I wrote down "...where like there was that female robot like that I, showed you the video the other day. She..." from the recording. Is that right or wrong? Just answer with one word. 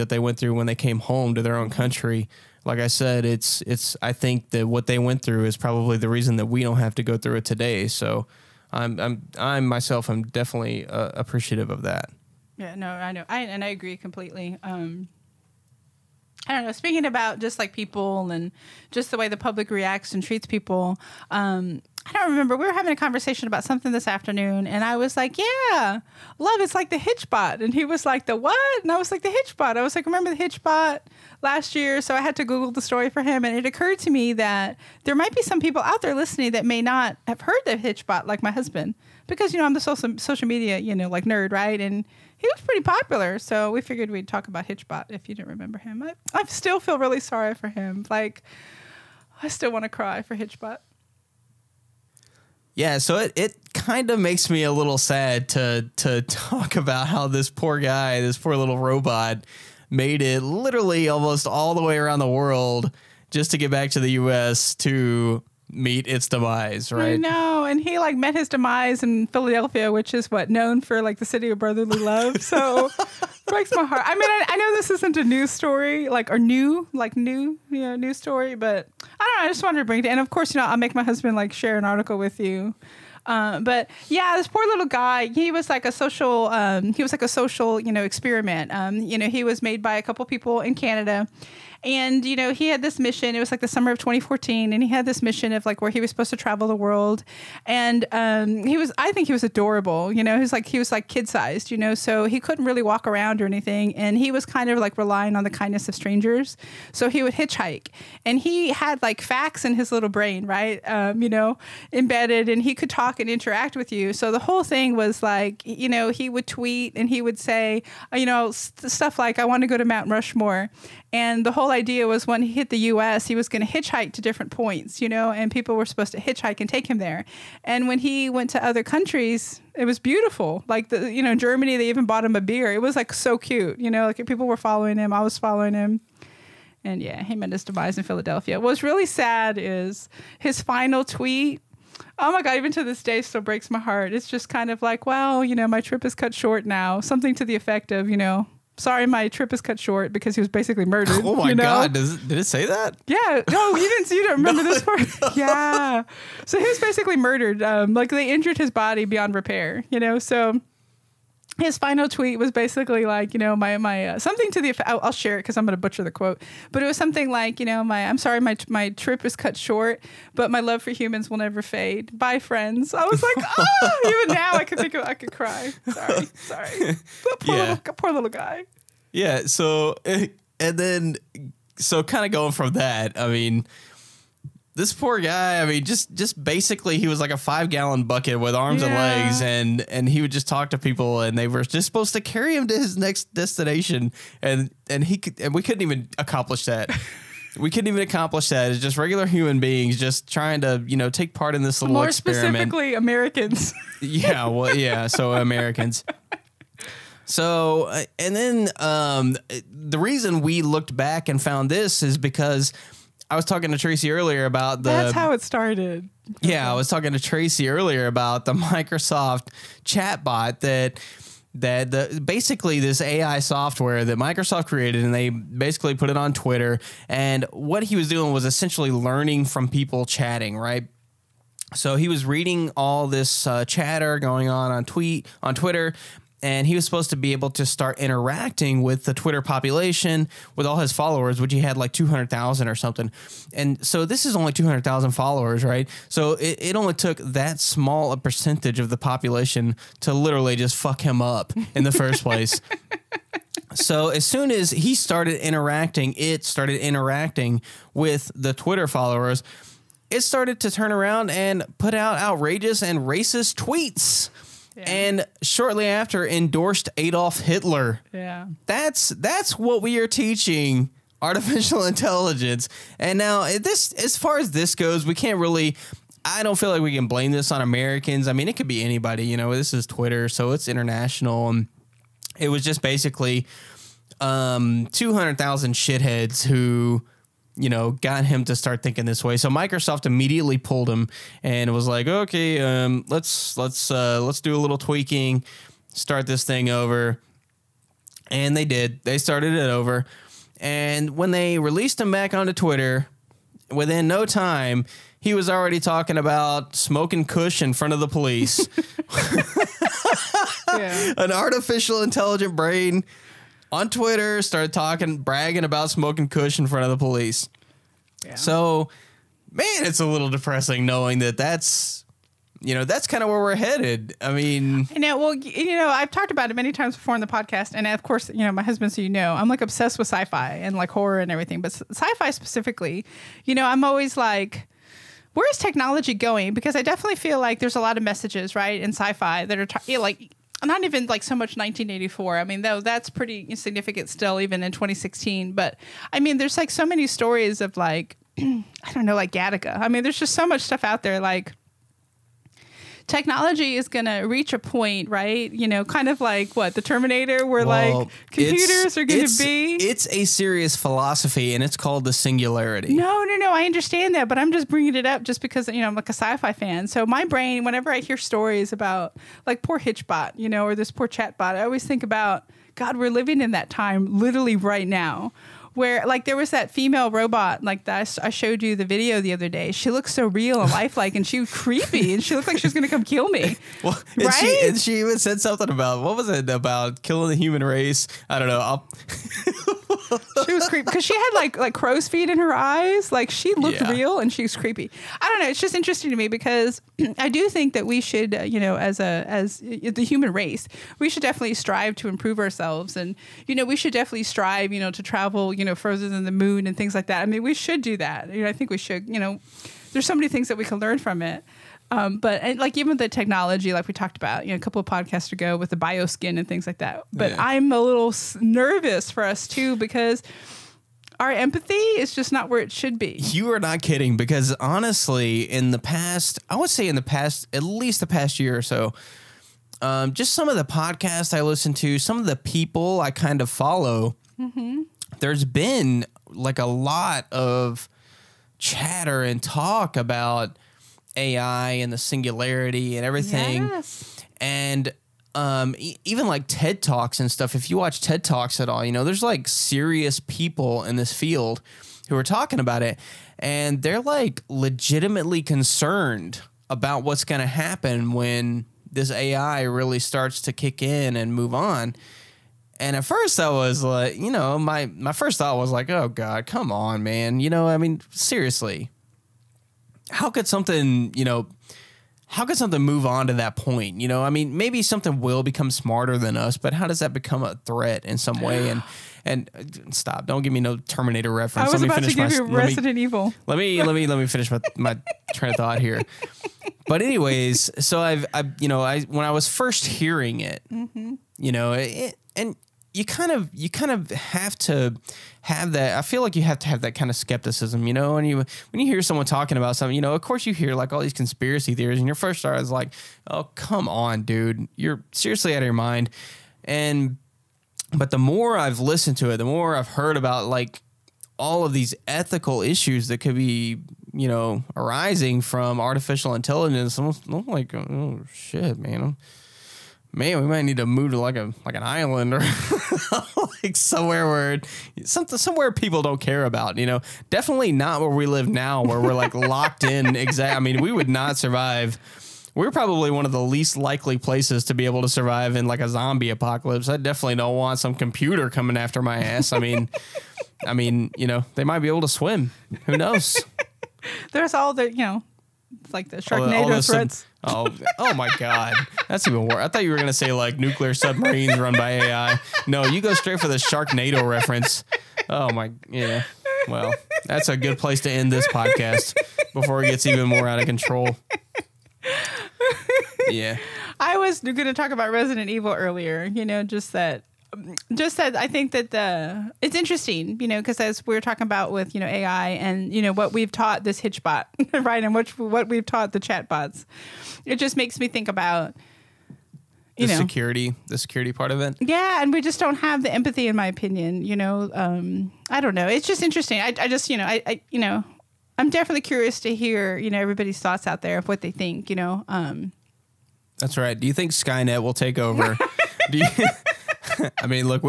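right.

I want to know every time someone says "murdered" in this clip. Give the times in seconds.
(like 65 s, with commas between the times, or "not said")
150 s, 157 s.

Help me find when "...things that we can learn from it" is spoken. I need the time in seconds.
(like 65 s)
410 s.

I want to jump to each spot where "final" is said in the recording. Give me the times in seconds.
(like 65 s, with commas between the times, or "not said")
140 s, 161 s.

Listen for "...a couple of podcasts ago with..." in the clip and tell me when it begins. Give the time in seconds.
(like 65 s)
414 s.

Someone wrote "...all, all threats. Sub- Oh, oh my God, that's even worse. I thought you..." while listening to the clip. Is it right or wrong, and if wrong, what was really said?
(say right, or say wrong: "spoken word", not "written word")
right.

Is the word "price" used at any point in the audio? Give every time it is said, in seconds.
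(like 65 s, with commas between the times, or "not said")
not said.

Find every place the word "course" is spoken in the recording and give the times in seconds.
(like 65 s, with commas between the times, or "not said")
80 s, 328 s, 500 s.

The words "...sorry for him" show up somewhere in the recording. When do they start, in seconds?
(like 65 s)
47 s.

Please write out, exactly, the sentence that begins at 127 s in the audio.
And when he went to other countries, it was beautiful.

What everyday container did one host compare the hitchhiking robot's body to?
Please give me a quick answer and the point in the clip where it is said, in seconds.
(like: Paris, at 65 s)
five gallon bucket, at 187 s.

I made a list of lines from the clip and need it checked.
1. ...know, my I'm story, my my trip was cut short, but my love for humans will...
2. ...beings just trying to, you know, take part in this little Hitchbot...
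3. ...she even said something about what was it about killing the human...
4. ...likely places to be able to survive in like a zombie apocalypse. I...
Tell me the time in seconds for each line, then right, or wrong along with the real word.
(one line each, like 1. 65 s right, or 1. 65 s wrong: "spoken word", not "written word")
1. 167 s wrong: "sorry", not "story"
2. 199 s wrong: "More", not "Hitchbot"
3. 384 s right
4. 533 s right.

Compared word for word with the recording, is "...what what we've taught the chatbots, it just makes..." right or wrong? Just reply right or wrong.
right.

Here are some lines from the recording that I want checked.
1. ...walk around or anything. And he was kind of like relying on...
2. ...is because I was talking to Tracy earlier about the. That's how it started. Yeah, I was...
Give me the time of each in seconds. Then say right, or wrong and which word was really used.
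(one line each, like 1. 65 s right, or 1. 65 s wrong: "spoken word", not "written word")
1. 102 s right
2. 212 s right.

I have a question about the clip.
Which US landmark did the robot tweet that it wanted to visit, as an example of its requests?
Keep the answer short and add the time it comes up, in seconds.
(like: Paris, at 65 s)
Mount Rushmore, at 119 s.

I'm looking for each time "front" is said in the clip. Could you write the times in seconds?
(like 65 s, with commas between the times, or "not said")
307 s, 316 s.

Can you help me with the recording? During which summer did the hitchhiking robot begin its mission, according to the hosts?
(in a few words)
2014.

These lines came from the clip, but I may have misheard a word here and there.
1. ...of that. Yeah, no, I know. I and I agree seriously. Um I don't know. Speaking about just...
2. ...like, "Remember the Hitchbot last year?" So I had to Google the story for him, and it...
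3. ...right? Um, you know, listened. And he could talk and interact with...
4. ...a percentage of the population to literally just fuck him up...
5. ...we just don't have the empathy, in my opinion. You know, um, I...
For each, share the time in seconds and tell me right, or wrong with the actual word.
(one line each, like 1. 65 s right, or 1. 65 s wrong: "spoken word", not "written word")
1. 11 s wrong: "completely", not "seriously"
2. 29 s right
3. 110 s wrong: "embedded", not "listened"
4. 248 s right
5. 582 s right.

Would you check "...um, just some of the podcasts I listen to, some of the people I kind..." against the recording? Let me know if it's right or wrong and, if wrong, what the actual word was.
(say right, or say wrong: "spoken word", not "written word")
right.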